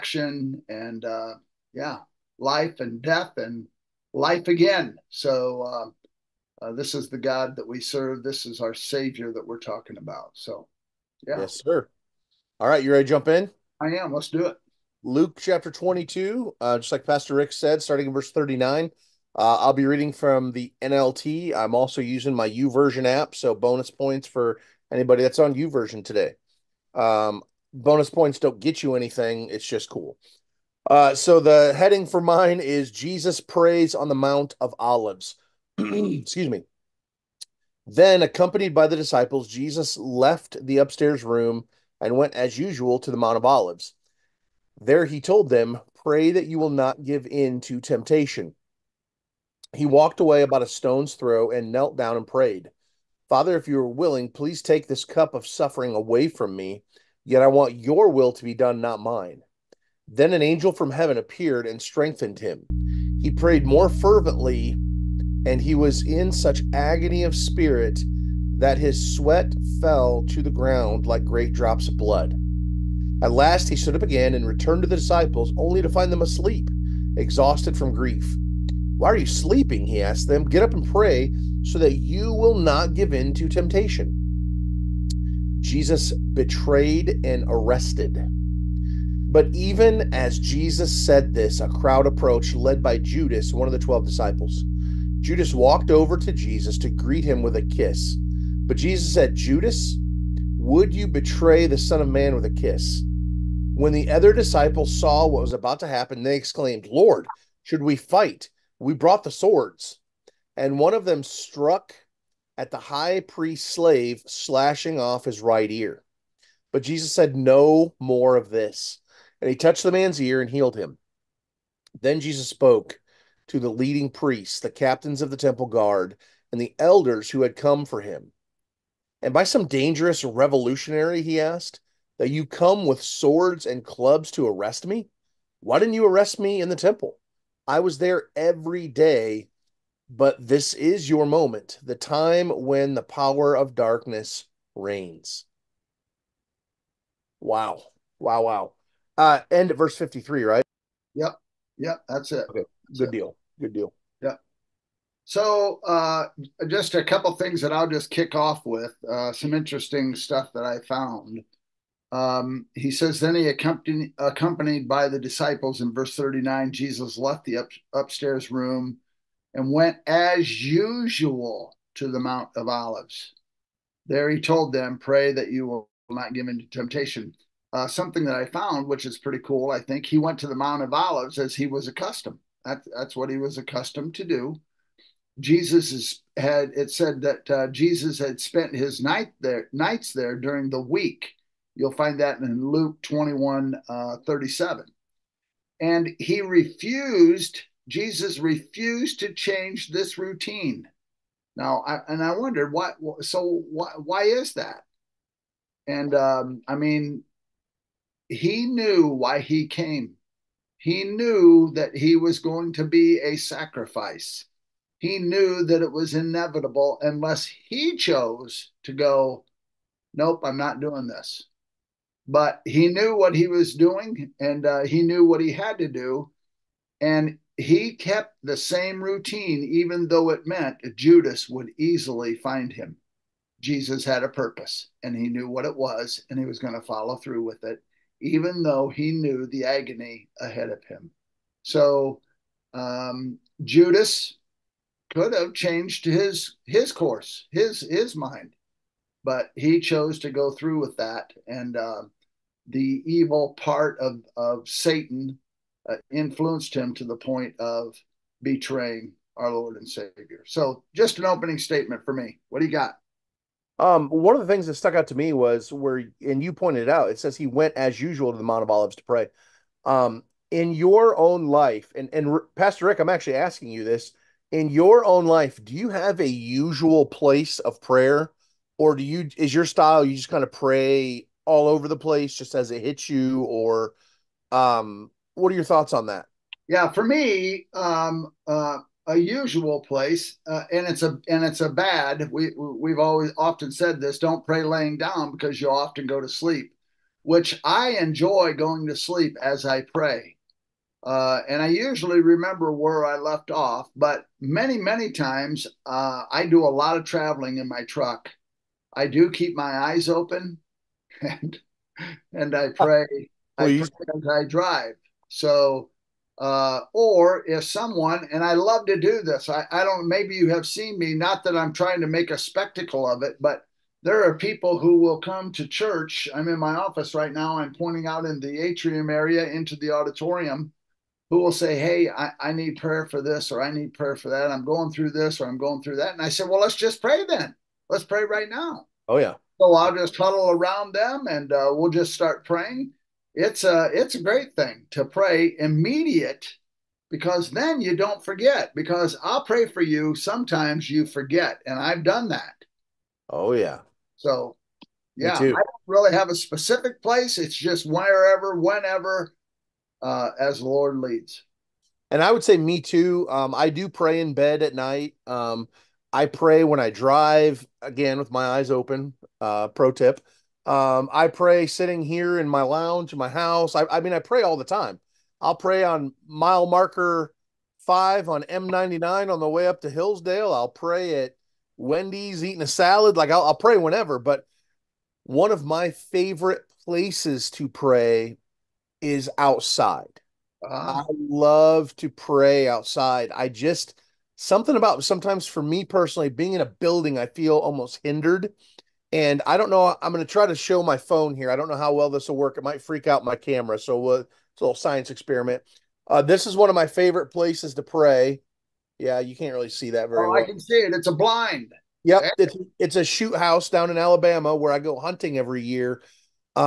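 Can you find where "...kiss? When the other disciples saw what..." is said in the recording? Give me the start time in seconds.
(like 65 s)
102 s.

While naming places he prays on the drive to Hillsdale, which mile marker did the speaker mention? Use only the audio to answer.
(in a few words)
5.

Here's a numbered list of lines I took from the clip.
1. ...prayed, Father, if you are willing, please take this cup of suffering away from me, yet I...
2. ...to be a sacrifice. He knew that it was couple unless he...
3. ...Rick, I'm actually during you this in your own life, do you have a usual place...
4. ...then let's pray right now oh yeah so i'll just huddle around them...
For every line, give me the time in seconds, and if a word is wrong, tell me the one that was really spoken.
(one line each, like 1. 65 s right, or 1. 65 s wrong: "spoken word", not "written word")
1. 52 s right
2. 212 s wrong: "inevitable", not "couple"
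3. 272 s wrong: "asking", not "during"
4. 337 s right.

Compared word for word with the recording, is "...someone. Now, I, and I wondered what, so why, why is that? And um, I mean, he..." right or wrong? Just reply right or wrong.
wrong.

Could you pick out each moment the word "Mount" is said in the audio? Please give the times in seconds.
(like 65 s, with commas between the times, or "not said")
34 s, 43 s, 172 s, 180 s, 268 s.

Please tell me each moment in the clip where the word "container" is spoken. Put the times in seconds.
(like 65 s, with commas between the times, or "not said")
not said.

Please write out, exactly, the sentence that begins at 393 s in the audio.
I just something about sometimes for me personally being in a building, I feel almost hindered.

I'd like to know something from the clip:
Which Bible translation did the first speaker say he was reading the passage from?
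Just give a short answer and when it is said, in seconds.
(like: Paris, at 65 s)
NLT, at 20 s.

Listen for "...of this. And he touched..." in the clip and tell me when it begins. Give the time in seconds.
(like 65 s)
118 s.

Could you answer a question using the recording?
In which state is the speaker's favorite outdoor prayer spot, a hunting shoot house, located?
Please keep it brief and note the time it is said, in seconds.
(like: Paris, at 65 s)
Alabama, at 413 s.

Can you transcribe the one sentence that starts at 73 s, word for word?
At last he stood up again and returned to the disciples, only to find them asleep, exhausted from grief.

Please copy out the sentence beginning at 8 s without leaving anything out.
This is our Savior that we're talking about.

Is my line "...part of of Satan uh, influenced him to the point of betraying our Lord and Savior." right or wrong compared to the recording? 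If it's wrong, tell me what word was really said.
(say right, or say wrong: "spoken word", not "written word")
right.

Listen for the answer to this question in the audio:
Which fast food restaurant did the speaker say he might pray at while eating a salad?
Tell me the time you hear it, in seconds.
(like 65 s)
381 s.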